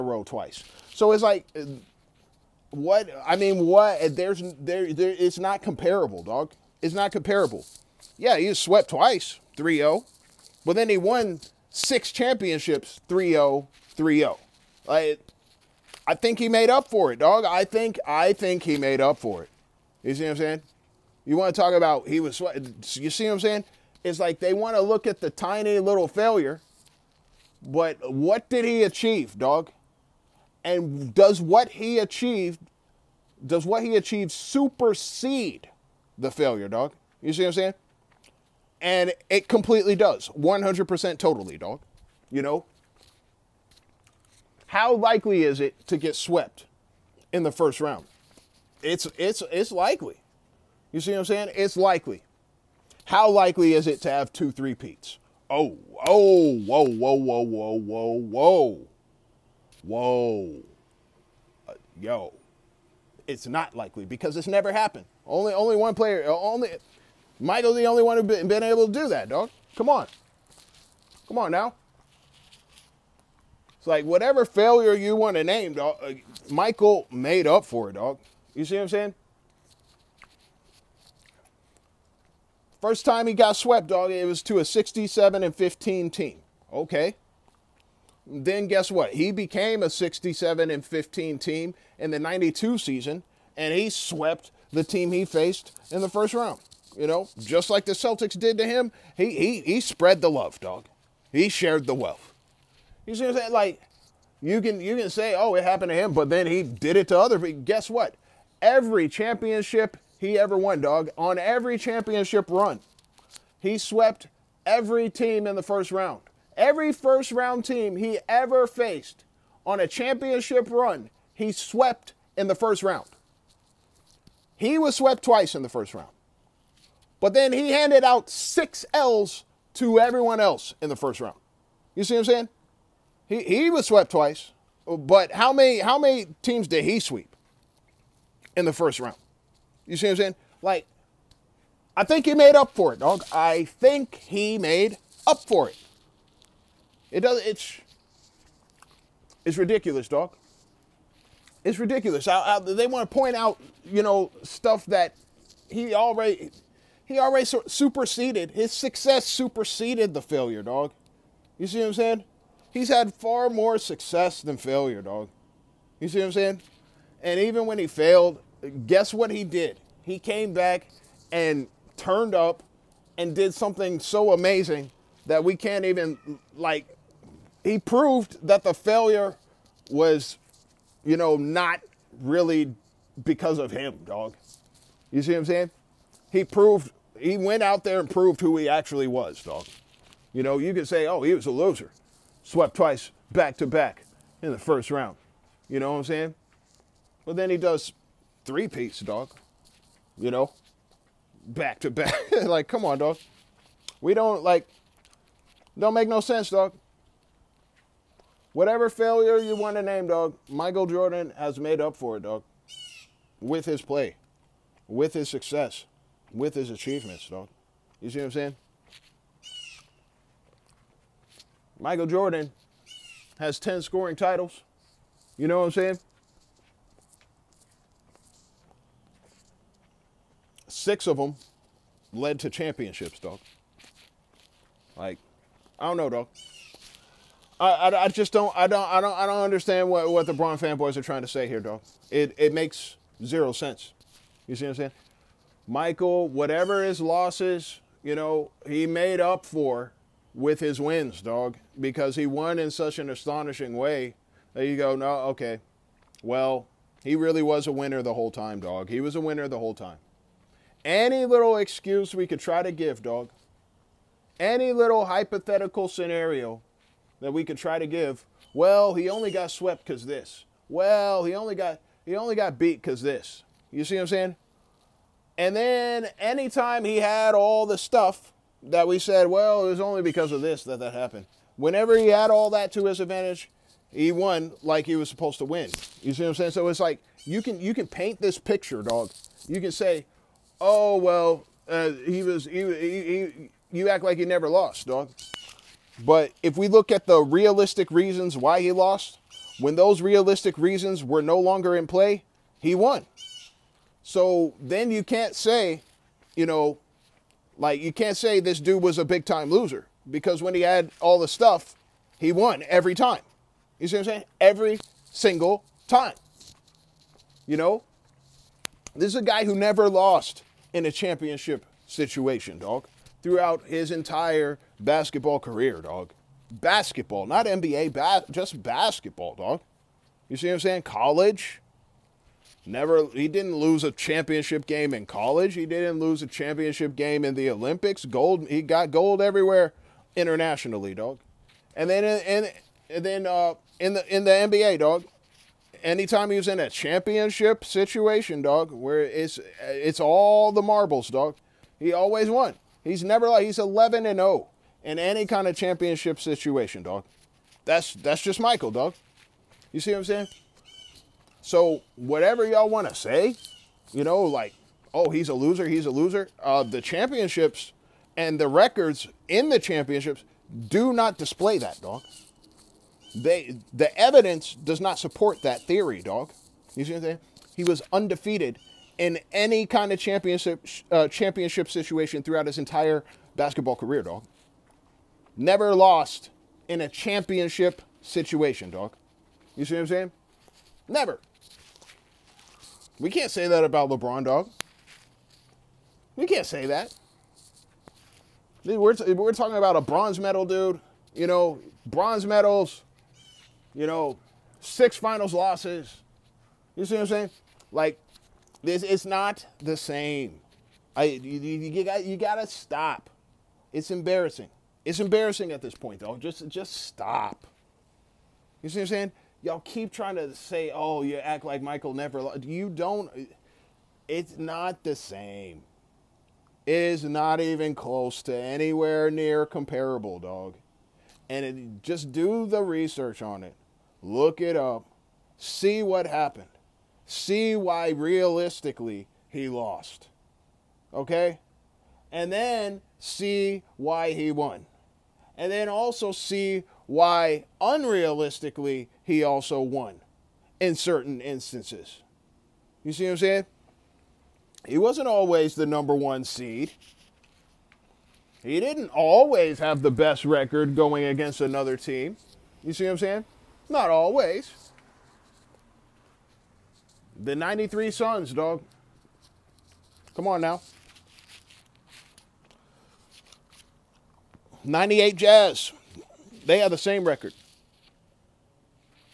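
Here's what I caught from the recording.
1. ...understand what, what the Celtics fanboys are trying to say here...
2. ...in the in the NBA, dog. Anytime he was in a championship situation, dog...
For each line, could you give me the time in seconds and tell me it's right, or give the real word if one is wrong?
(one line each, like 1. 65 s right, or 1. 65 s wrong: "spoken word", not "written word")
1. 239 s wrong: "Bron", not "Celtics"
2. 343 s right.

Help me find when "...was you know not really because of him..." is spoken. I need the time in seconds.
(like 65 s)
179 s.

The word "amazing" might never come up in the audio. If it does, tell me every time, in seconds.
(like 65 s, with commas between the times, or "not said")
174 s.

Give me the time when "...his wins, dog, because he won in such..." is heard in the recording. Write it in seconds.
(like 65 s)
250 s.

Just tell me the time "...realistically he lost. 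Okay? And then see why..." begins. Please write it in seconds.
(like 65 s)
437 s.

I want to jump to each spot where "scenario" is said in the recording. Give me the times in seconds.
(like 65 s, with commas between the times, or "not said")
265 s.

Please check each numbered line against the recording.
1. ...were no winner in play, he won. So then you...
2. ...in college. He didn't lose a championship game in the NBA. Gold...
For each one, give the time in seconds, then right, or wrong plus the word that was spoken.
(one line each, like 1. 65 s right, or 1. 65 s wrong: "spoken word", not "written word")
1. 301 s wrong: "longer", not "winner"
2. 334 s wrong: "Olympics", not "NBA".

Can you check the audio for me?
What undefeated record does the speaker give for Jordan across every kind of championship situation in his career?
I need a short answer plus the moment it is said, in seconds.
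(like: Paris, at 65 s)
11-0, at 353 s.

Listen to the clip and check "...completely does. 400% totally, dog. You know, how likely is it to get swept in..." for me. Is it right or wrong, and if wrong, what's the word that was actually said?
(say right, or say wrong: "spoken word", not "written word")
wrong: "100", not "400".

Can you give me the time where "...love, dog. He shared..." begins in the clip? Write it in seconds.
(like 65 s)
100 s.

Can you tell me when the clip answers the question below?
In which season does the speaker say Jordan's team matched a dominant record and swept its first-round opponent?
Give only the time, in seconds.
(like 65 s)
92 s.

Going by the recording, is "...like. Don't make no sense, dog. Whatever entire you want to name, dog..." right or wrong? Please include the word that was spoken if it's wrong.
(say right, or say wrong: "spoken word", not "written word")
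wrong: "failure", not "entire".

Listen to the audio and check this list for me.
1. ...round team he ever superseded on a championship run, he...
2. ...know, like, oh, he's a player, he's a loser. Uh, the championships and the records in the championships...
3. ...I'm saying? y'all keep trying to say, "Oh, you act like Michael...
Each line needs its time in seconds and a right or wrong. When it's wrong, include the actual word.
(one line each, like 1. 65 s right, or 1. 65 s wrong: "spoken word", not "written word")
1. 117 s wrong: "faced", not "superseded"
2. 364 s wrong: "loser", not "player"
3. 418 s right.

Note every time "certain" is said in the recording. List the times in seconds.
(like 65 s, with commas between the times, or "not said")
450 s.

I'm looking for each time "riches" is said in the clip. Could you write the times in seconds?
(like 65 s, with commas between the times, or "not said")
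not said.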